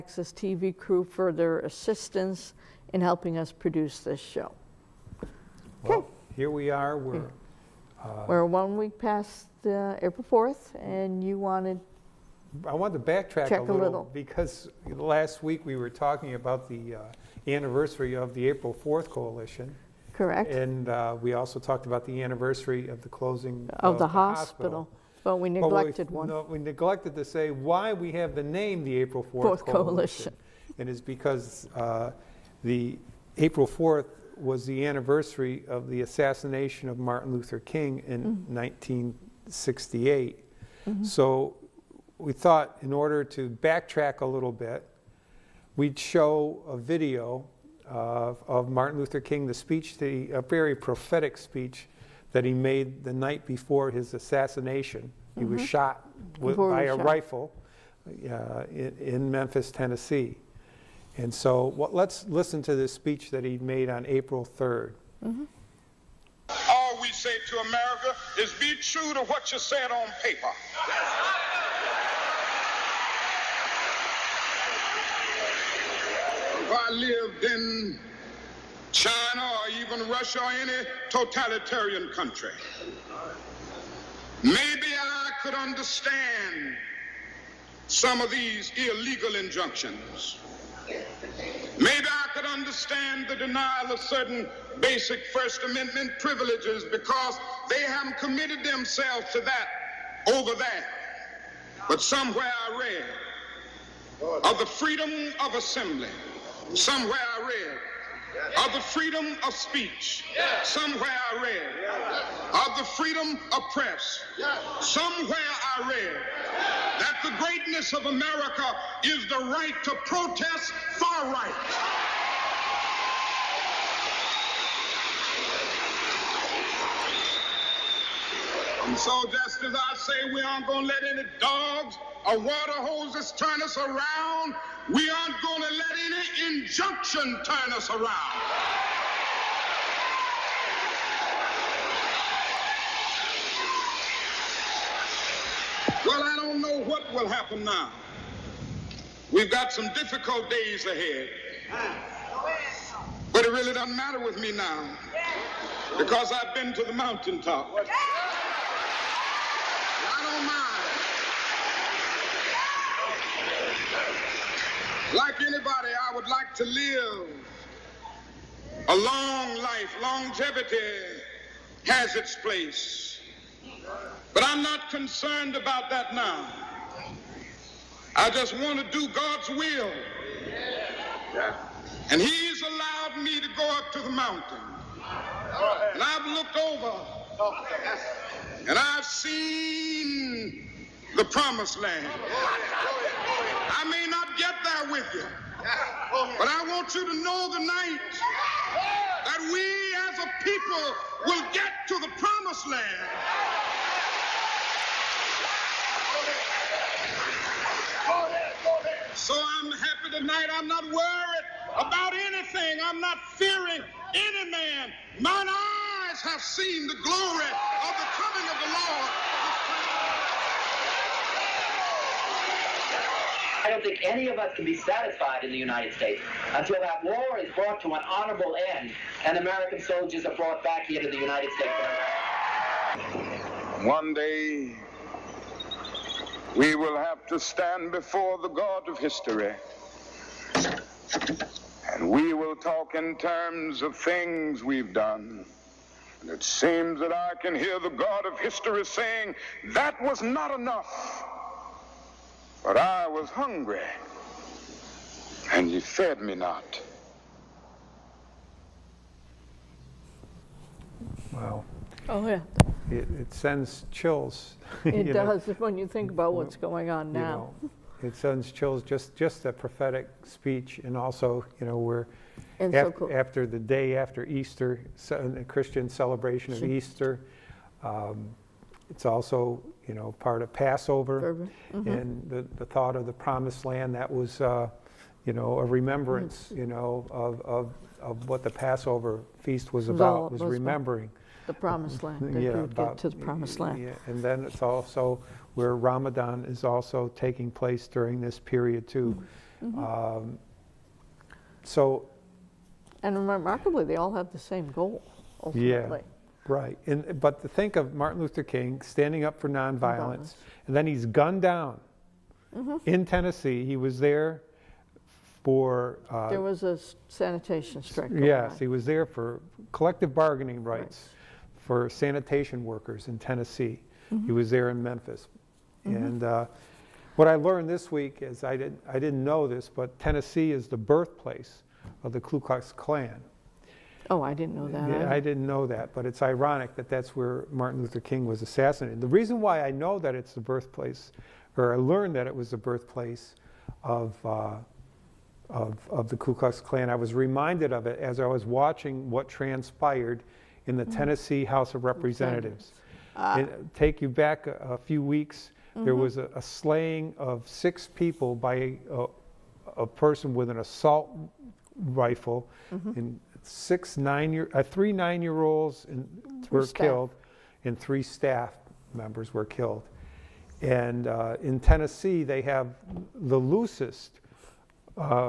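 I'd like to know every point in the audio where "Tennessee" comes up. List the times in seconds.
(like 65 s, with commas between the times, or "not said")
59 s, 313 s, 323 s, 329 s, 350 s, 371 s.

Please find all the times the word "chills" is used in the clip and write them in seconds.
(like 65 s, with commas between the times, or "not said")
263 s, 268 s.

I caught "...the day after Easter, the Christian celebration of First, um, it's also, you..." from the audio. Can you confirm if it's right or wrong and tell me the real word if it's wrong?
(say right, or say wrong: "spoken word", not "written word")
wrong: "Easter", not "First".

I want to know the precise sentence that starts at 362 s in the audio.
in six nine year, uh, three nine year olds were staff.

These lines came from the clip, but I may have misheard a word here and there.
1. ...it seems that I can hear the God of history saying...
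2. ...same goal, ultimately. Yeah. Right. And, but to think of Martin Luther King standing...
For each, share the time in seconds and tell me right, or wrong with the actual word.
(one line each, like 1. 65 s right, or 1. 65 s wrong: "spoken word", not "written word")
1. 246 s right
2. 304 s right.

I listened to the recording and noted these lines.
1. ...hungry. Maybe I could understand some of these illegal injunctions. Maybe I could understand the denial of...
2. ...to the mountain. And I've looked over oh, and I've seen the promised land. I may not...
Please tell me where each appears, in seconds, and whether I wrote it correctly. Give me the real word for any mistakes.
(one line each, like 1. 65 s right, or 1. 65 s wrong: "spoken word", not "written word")
1. 82 s wrong: "country", not "hungry"
2. 183 s right.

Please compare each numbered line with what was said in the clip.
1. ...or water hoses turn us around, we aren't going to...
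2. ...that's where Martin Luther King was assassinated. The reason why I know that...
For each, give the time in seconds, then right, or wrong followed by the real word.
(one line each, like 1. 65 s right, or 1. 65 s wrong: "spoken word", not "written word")
1. 132 s right
2. 336 s right.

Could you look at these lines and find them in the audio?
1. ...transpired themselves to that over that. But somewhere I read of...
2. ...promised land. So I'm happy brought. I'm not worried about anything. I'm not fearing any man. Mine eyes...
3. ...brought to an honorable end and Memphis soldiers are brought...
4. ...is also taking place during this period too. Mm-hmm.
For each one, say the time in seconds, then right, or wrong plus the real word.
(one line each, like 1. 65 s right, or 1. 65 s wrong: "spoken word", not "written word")
1. 98 s wrong: "committed", not "transpired"
2. 202 s wrong: "tonight", not "brought"
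3. 227 s wrong: "American", not "Memphis"
4. 296 s right.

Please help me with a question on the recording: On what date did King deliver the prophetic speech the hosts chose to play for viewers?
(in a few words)
April 3rd.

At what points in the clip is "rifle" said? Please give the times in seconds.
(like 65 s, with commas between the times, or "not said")
57 s, 361 s.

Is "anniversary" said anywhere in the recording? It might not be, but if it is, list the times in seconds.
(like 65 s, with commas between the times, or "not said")
17 s, 22 s, 34 s.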